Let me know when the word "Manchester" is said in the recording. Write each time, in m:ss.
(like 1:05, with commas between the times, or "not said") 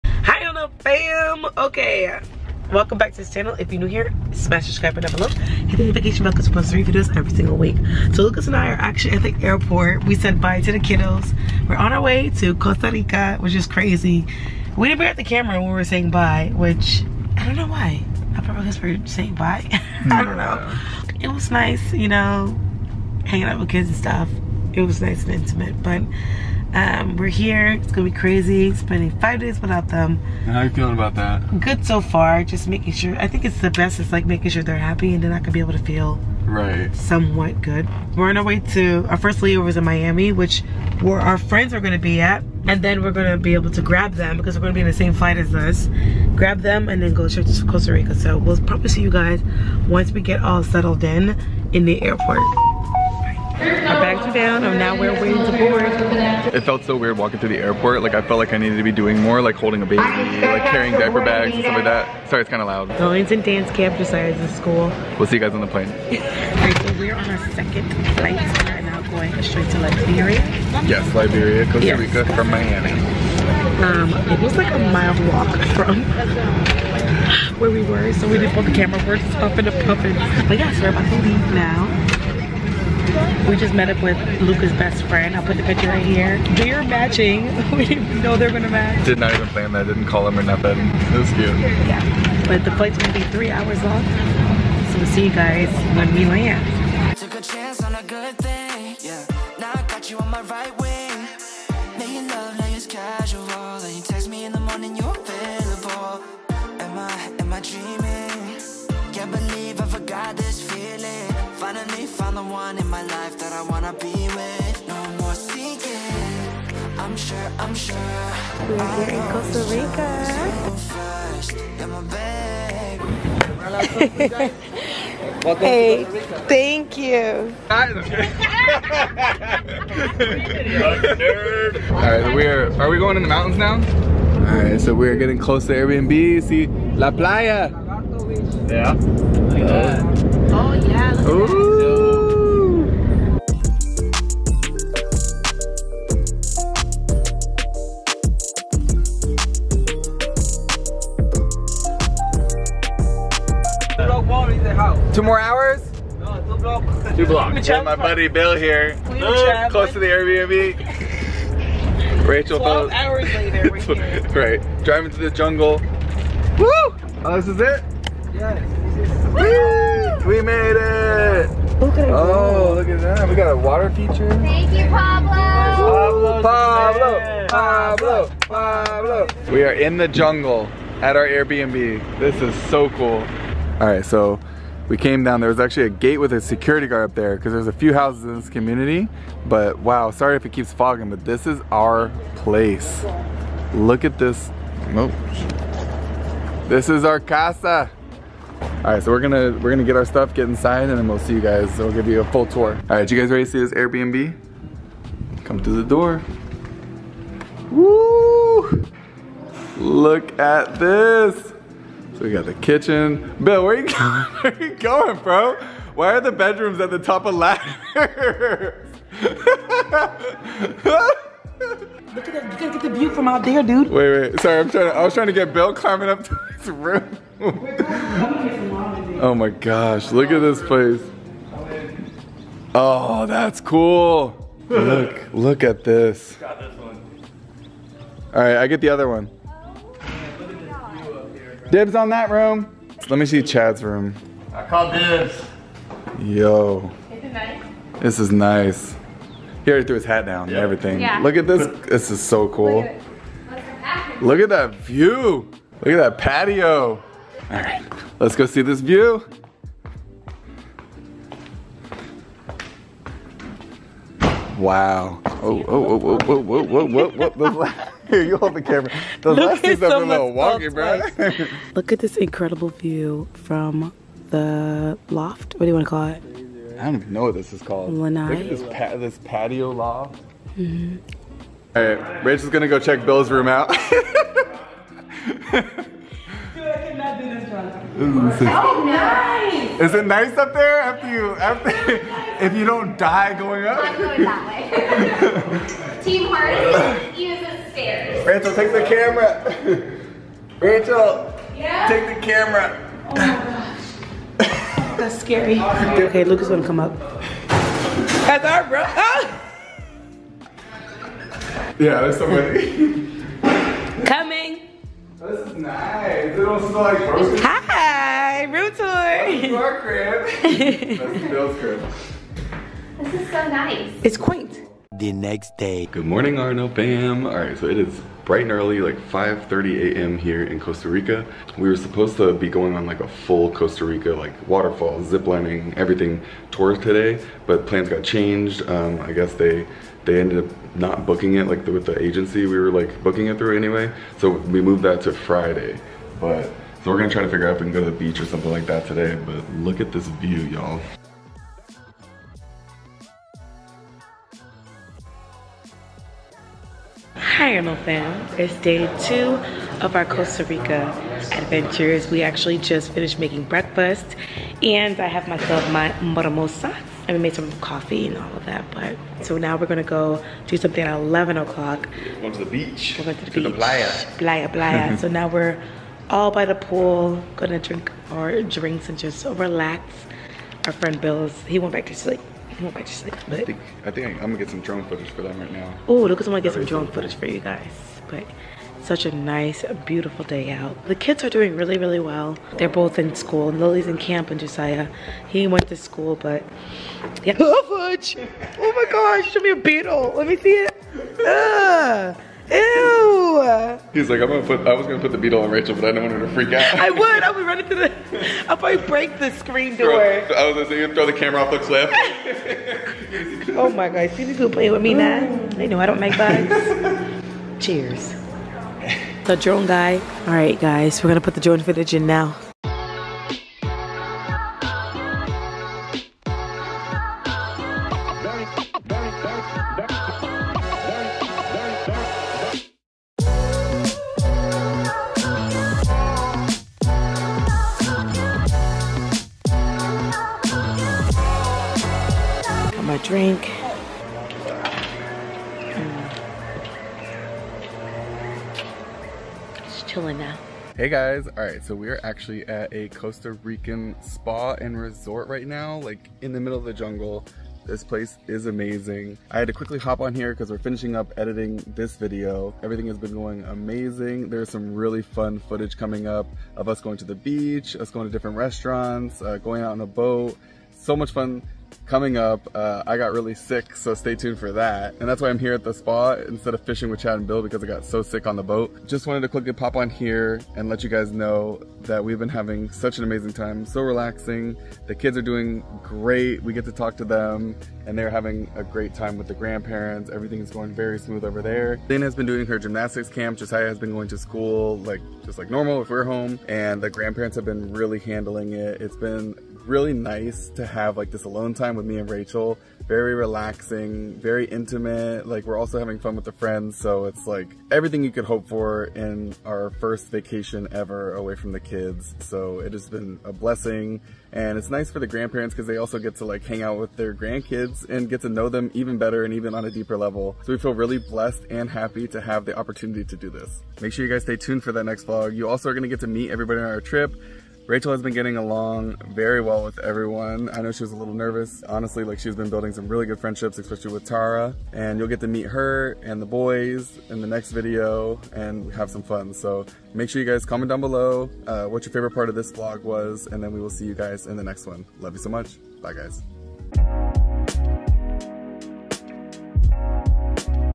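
not said.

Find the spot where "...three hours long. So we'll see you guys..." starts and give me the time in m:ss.
1:33.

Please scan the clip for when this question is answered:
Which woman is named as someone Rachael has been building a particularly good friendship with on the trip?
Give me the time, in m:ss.
8:54.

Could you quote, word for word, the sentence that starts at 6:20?
Our friend Bill's, he went back to sleep.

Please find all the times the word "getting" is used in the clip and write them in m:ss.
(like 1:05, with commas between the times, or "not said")
2:15, 8:48.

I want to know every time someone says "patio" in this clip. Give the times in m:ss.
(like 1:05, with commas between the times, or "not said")
4:16, 4:39.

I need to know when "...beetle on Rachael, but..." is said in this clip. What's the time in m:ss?
6:45.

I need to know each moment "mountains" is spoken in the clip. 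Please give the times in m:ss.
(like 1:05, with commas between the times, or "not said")
2:13.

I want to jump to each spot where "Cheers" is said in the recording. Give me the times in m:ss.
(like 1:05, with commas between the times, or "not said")
6:57.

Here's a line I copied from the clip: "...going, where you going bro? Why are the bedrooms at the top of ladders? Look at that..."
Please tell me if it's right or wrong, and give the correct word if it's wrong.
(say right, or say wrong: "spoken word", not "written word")
right.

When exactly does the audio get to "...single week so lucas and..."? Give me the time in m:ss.
0:07.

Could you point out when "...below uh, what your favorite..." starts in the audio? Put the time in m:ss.
9:00.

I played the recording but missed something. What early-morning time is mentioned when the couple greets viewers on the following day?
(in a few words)
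5:30 a.m.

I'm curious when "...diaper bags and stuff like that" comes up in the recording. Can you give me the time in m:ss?
1:00.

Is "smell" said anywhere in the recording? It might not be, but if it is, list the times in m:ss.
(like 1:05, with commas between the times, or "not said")
5:16.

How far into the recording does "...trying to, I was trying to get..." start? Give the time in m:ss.
3:44.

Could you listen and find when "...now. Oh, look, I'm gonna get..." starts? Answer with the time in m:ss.
6:25.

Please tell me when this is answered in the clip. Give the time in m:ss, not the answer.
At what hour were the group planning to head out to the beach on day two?
6:10.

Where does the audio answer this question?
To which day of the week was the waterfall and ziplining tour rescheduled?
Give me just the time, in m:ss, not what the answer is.
5:45.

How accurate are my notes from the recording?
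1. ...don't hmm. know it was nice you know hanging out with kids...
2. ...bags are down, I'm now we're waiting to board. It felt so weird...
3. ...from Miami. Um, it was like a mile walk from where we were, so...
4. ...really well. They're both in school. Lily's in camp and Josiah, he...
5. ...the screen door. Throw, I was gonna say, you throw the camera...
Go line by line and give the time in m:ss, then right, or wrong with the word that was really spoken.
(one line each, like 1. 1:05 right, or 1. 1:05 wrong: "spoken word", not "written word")
1. 0:20 right
2. 0:54 right
3. 1:12 right
4. 6:31 right
5. 6:49 right.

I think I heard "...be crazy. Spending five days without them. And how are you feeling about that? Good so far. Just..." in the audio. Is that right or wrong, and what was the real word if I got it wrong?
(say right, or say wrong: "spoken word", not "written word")
right.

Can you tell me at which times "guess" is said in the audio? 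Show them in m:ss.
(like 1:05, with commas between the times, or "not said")
0:18, 5:39.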